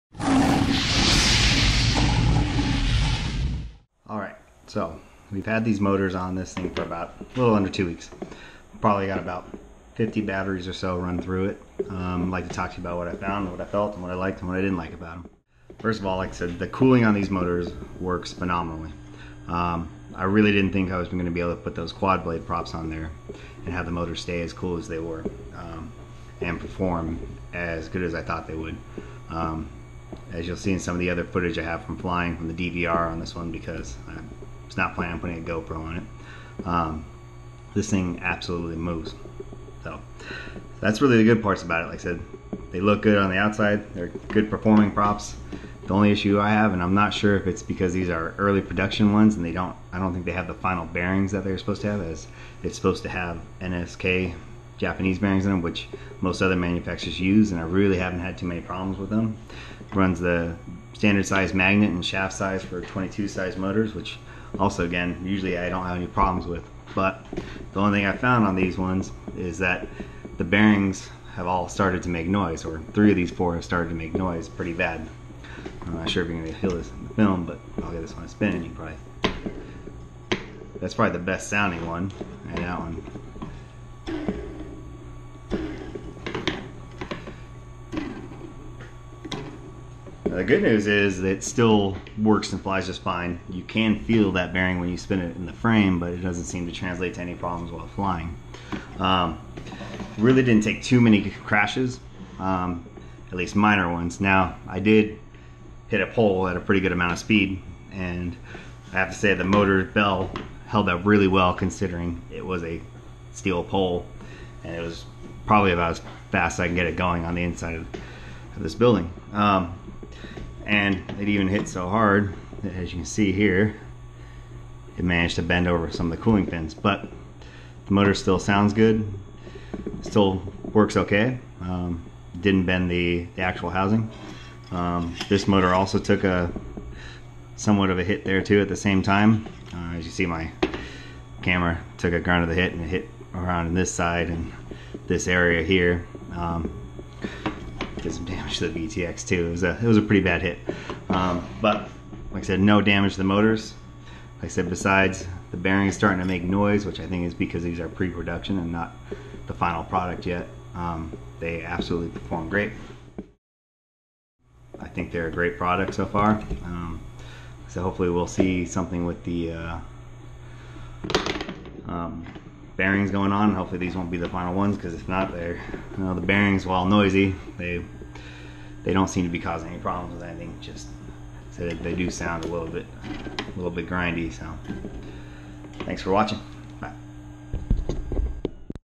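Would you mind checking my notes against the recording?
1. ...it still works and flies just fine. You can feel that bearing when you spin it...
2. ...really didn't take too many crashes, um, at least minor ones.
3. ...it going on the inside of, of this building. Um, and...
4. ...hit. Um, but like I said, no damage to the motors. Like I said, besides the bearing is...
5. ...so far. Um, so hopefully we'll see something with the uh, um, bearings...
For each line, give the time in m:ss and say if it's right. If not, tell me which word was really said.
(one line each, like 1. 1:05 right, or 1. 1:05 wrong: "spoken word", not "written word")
1. 1:31 right
2. 1:40 right
3. 1:56 right
4. 2:30 right
5. 2:45 right.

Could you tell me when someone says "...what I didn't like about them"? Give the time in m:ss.
0:14.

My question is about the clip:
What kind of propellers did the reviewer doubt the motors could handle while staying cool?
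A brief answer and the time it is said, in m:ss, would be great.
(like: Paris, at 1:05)
quad blade props, at 0:21.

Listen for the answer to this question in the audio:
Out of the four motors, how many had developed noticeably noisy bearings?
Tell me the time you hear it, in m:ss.
1:12.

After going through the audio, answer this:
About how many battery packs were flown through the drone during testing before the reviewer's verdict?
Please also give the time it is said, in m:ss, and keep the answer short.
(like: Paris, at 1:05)
50, at 0:09.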